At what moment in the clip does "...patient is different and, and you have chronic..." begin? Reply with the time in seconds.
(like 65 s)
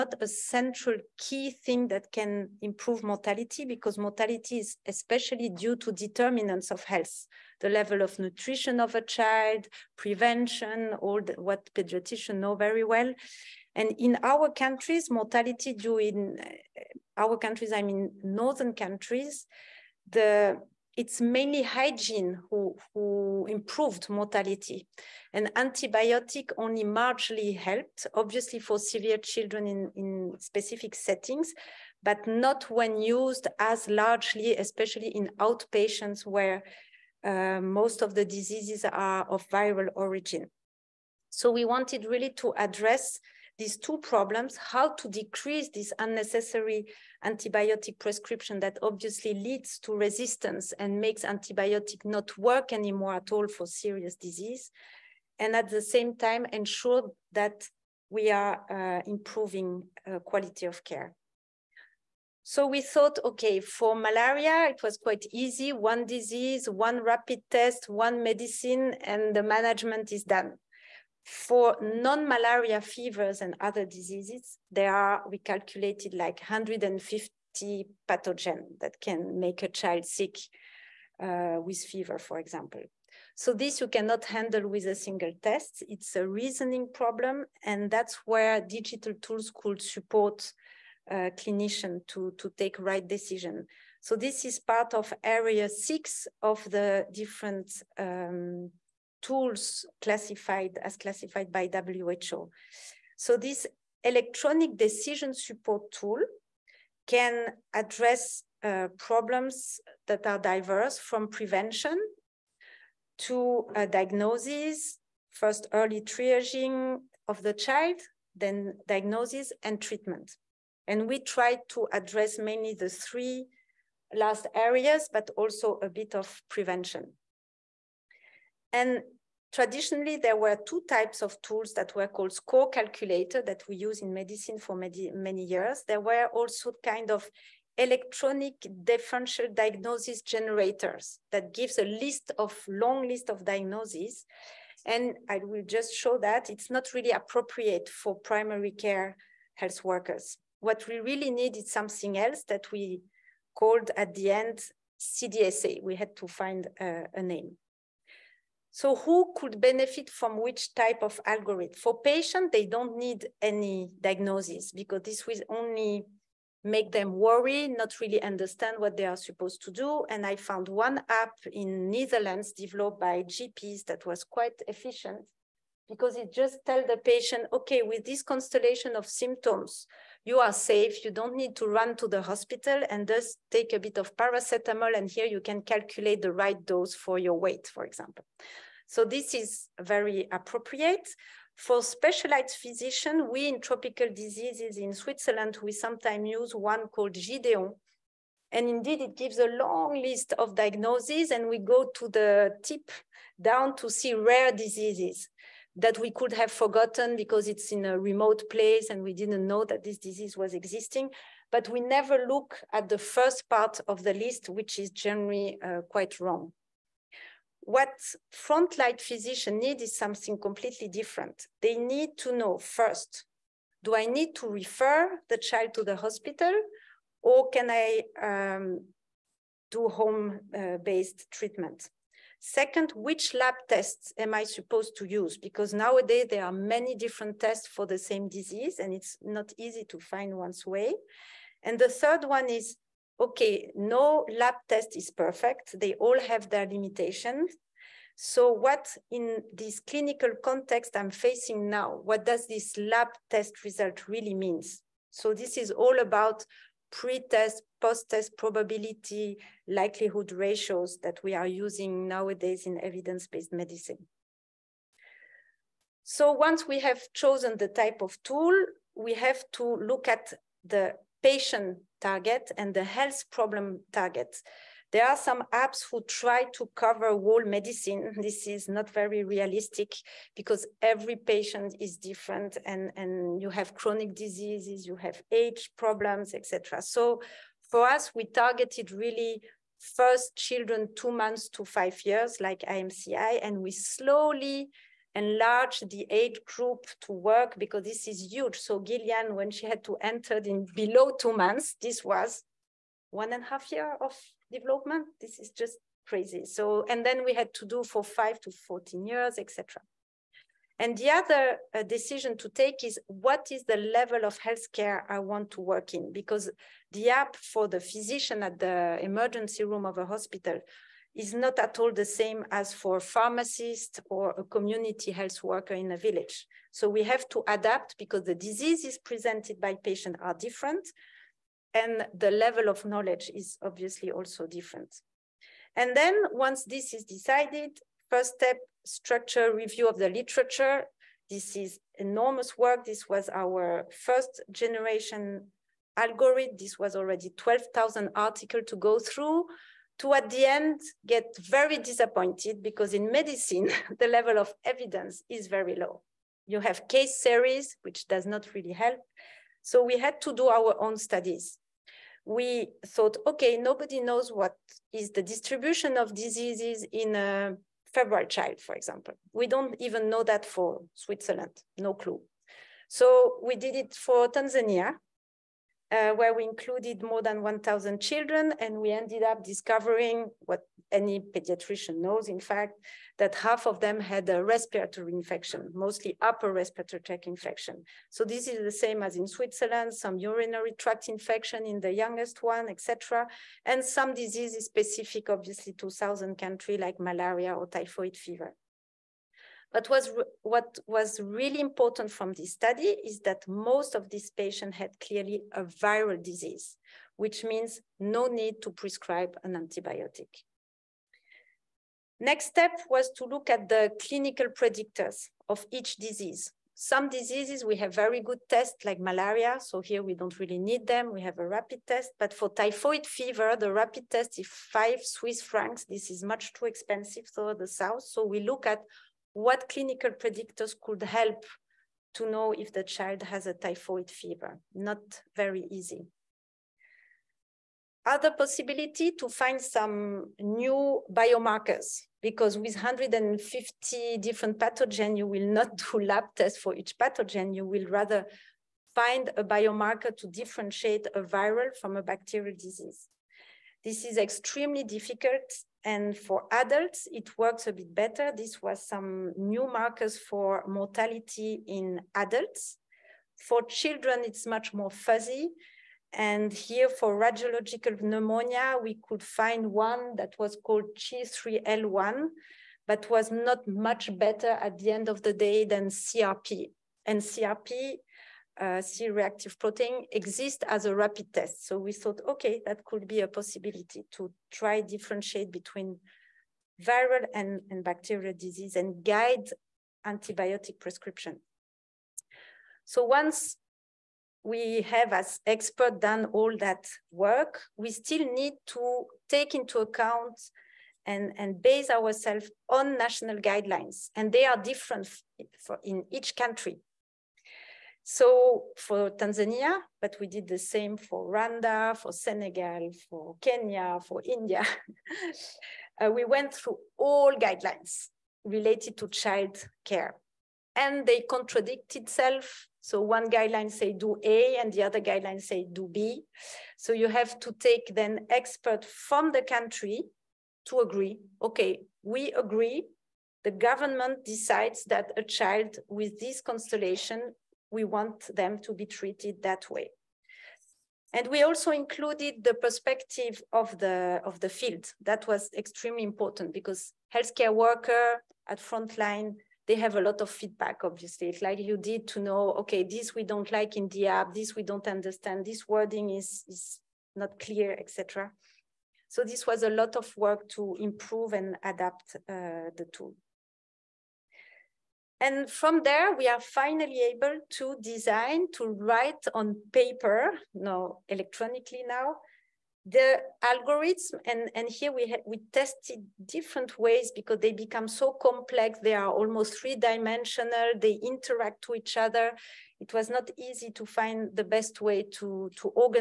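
281 s.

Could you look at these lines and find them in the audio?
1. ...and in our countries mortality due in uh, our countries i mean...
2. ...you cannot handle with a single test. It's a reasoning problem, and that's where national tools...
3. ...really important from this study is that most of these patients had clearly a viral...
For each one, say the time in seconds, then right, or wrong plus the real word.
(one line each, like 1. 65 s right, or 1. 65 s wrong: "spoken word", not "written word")
1. 13 s right
2. 83 s wrong: "digital", not "national"
3. 401 s right.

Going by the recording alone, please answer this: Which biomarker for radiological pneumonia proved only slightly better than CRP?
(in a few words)
G3L1.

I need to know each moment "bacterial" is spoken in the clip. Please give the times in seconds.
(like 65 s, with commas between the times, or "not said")
452 s, 487 s.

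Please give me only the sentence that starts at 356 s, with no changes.
You have case series, which does not really help.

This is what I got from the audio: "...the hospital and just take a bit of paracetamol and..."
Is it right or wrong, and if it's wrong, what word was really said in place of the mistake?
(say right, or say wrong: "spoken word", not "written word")
right.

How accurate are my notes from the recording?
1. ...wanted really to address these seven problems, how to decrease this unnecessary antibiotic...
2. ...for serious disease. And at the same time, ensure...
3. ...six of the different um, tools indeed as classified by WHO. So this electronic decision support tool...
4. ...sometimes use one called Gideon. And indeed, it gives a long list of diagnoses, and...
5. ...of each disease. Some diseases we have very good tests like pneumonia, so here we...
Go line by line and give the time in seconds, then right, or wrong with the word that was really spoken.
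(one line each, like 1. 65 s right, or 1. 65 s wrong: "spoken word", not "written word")
1. 41 s wrong: "two", not "seven"
2. 53 s right
3. 95 s wrong: "classified", not "indeed"
4. 195 s right
5. 415 s wrong: "malaria", not "pneumonia".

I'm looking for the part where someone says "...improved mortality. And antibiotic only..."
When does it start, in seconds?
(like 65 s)
23 s.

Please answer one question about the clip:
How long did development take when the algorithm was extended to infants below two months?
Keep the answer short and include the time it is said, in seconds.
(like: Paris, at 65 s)
1.5 years, at 303 s.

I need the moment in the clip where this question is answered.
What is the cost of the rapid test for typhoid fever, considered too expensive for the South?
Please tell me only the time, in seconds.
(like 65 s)
424 s.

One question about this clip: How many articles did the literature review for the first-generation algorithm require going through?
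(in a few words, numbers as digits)
12,000.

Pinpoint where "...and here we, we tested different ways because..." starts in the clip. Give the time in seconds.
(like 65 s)
574 s.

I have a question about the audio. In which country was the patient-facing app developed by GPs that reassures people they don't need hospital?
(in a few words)
Netherlands.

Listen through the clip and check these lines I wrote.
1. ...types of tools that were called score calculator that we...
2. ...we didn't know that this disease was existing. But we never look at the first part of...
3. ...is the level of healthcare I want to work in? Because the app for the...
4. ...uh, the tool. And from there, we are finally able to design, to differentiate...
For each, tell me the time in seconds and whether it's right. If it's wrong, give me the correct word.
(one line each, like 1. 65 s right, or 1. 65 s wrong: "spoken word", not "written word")
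1. 130 s right
2. 209 s right
3. 313 s right
4. 562 s wrong: "write", not "differentiate".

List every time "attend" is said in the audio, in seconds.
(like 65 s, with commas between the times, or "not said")
not said.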